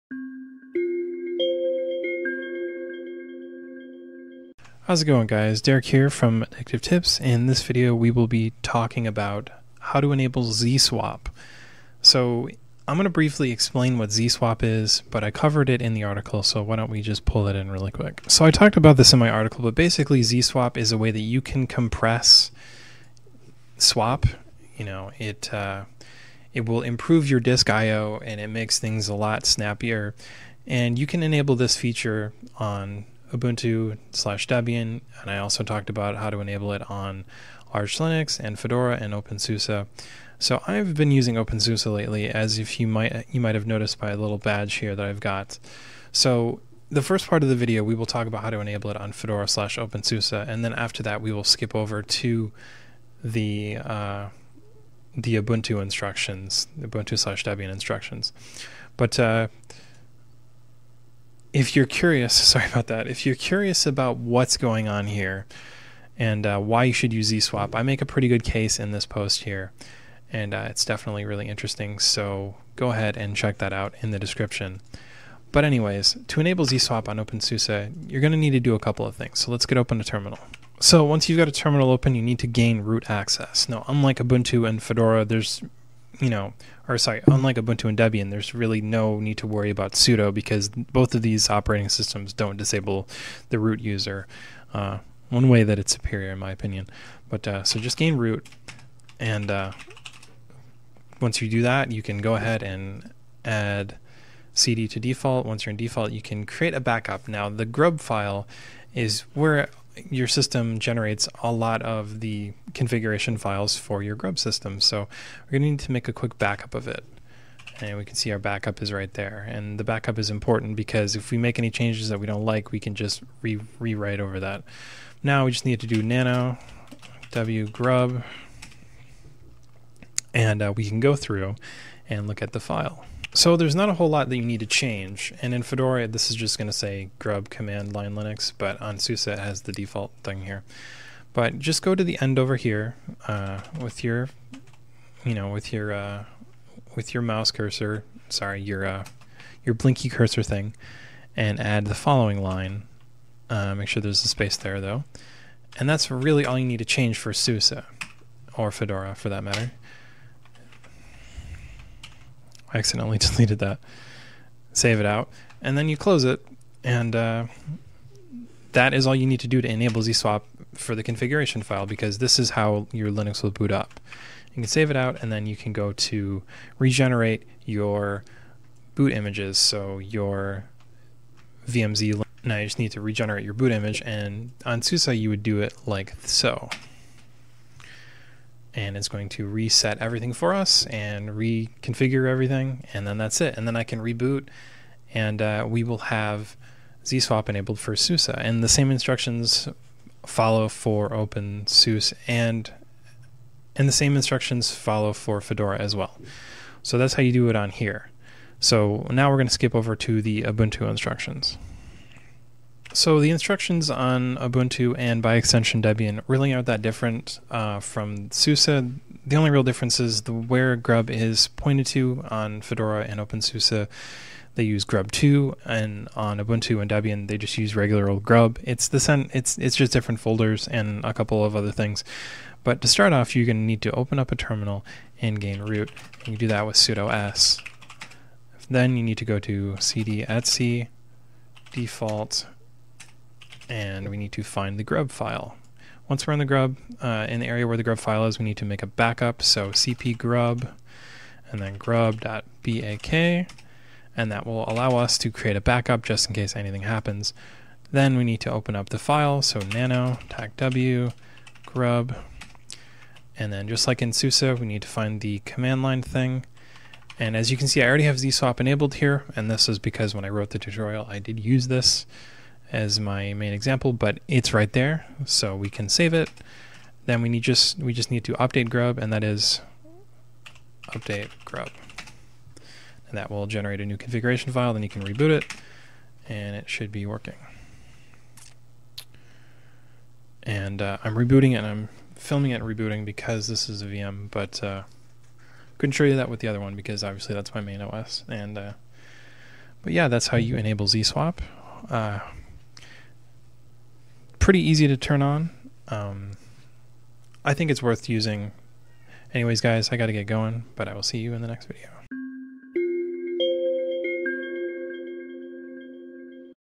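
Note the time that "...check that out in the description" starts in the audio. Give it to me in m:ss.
1:13.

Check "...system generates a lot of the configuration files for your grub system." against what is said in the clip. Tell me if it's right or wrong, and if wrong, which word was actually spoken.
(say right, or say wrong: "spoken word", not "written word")
right.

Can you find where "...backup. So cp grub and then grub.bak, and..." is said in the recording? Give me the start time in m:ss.
4:08.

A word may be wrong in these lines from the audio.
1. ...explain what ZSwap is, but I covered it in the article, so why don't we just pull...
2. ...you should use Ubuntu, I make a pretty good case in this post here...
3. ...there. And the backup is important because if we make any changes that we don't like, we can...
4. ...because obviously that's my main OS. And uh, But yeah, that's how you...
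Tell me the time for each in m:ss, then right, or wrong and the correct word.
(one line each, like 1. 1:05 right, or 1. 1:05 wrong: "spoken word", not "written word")
1. 0:13 right
2. 1:06 wrong: "ZSwap", not "Ubuntu"
3. 1:59 right
4. 4:56 right.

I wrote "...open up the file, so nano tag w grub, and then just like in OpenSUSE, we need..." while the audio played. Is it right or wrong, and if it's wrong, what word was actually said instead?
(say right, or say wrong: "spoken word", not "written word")
wrong: "SUSE", not "OpenSUSE".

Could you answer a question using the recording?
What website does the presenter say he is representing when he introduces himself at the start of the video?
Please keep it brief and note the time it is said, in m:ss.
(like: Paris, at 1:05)
AddictiveTips, at 0:06.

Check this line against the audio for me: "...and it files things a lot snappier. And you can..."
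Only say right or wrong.
wrong.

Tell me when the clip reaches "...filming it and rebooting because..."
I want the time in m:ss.
4:52.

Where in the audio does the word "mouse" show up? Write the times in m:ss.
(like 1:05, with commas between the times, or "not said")
2:27.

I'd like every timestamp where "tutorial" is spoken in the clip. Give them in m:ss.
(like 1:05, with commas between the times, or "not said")
4:30.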